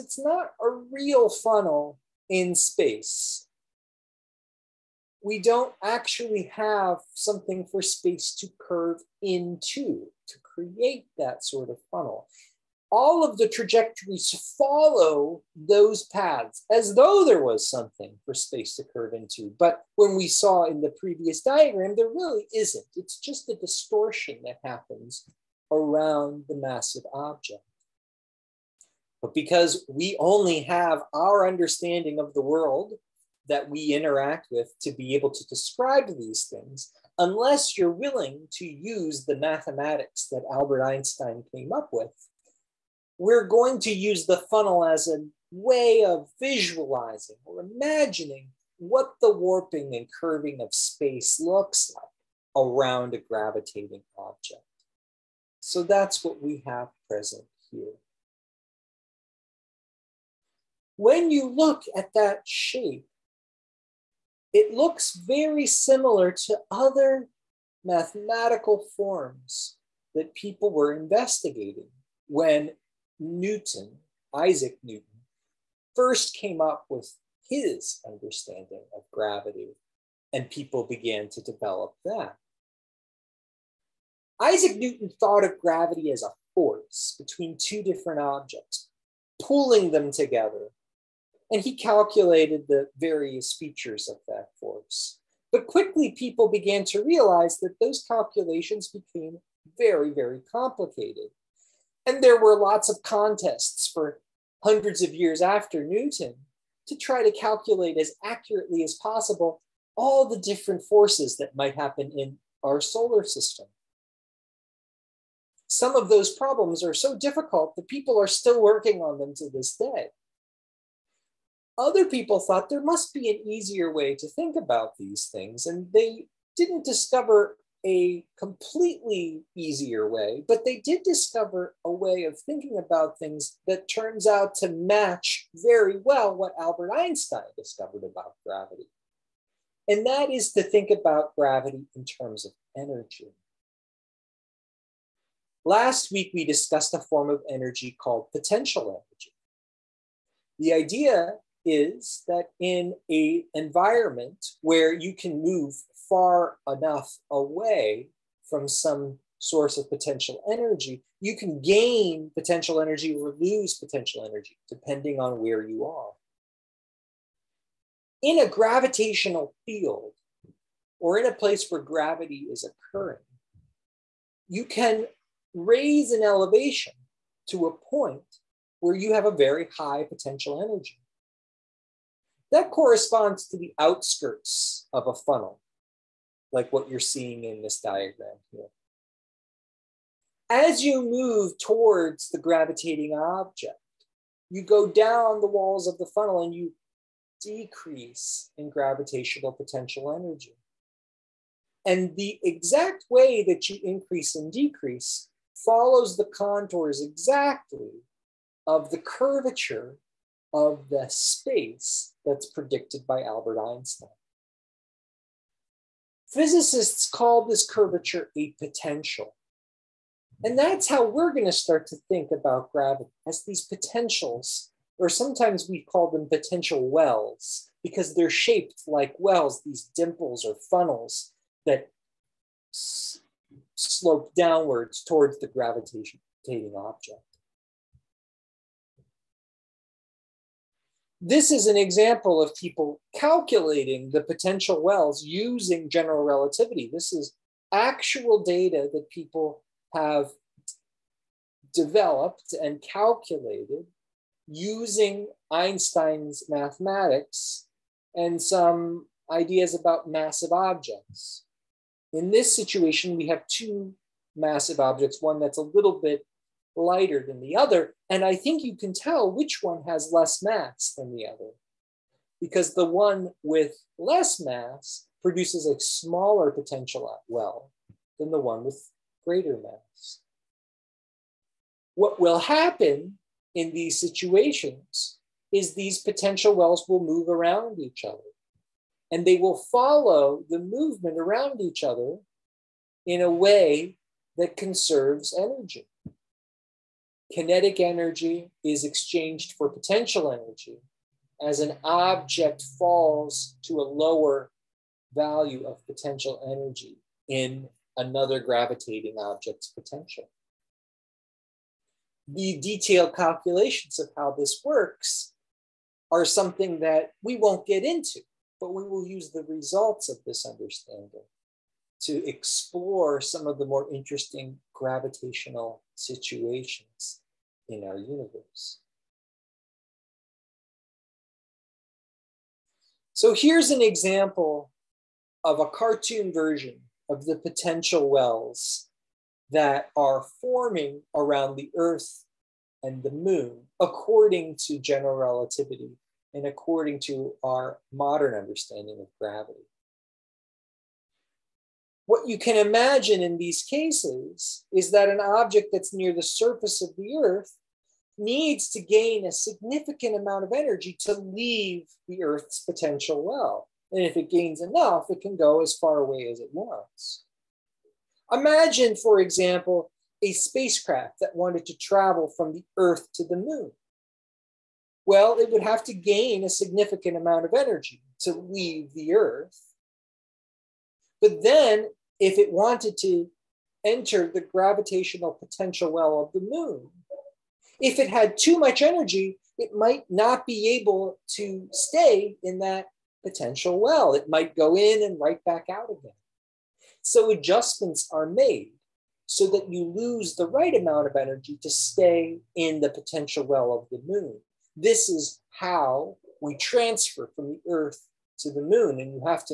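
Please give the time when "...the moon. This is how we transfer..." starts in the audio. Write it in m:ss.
6:43.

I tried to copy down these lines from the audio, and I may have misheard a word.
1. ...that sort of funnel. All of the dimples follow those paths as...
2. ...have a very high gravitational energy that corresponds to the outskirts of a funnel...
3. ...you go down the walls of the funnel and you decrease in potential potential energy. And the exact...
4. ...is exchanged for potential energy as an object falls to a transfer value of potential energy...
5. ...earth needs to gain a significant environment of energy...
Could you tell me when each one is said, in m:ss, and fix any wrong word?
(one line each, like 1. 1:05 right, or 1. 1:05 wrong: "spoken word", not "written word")
1. 0:11 wrong: "trajectories", not "dimples"
2. 2:59 wrong: "potential", not "gravitational"
3. 3:14 wrong: "gravitational", not "potential"
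4. 4:58 wrong: "lower", not "transfer"
5. 5:57 wrong: "amount", not "environment".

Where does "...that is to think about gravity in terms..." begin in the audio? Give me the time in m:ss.
2:20.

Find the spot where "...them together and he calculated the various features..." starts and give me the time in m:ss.
1:29.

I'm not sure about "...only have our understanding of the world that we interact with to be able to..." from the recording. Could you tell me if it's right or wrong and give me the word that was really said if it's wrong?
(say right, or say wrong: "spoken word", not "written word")
right.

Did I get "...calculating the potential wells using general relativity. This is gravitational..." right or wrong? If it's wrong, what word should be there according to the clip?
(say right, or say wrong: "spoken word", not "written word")
wrong: "actual", not "gravitational".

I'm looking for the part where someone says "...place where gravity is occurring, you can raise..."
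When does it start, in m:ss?
2:51.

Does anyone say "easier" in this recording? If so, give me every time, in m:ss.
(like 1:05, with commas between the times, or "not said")
2:03, 2:09.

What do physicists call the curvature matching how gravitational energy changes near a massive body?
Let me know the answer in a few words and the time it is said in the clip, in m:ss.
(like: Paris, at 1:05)
A potential, at 3:38.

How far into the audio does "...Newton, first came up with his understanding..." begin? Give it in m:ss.
1:14.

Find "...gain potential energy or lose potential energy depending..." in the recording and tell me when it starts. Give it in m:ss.
2:41.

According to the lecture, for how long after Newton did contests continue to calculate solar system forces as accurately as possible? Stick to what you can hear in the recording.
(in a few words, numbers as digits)
Hundreds of years.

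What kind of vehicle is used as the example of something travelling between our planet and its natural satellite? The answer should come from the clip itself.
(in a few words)
A spacecraft.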